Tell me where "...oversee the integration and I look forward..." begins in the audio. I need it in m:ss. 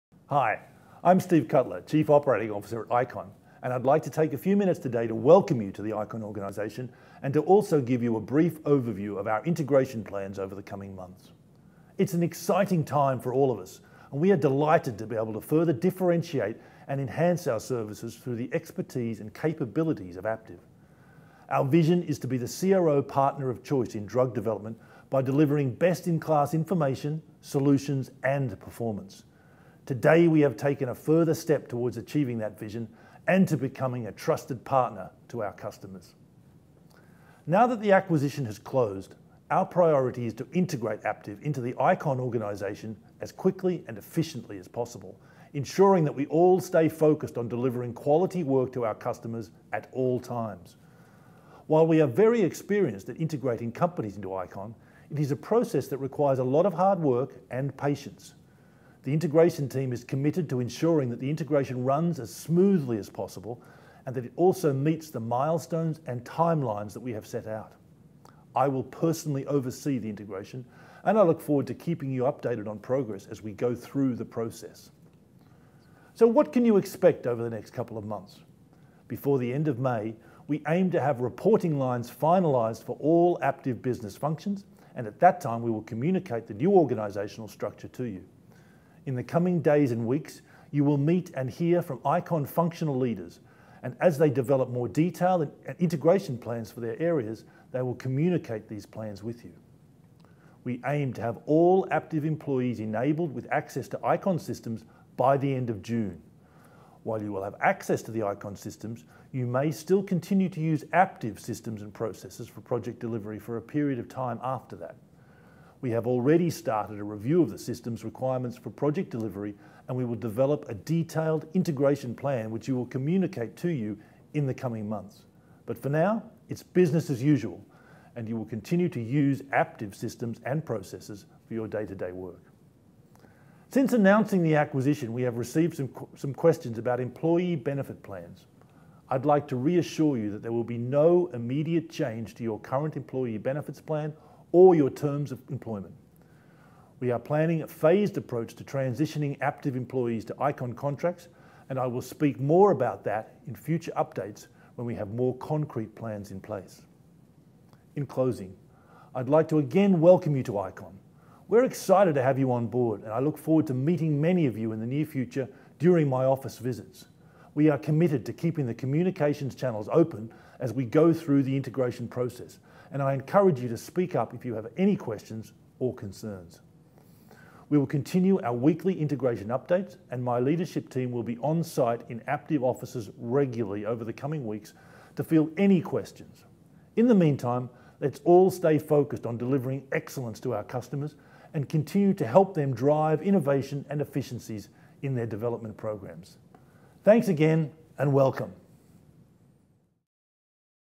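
1:09.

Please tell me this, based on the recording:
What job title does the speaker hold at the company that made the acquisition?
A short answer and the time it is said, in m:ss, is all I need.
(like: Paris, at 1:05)
Chief Operating Officer, at 0:01.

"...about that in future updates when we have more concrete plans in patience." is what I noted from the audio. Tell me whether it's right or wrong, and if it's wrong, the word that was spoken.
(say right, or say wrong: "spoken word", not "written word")
wrong: "place", not "patience".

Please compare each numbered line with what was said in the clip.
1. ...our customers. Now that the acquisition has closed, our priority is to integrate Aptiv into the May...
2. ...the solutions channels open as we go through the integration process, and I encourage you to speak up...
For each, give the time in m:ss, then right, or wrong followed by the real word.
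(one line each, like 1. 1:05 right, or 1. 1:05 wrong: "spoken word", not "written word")
1. 0:35 wrong: "ICON", not "May"
2. 2:48 wrong: "communications", not "solutions".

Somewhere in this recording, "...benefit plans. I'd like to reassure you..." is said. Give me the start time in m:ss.
2:17.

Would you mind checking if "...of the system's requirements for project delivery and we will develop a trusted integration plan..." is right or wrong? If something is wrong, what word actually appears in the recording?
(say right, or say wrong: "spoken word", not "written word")
wrong: "detailed", not "trusted".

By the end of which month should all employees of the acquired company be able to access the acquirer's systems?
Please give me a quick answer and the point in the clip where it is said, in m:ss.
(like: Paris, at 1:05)
June, at 1:45.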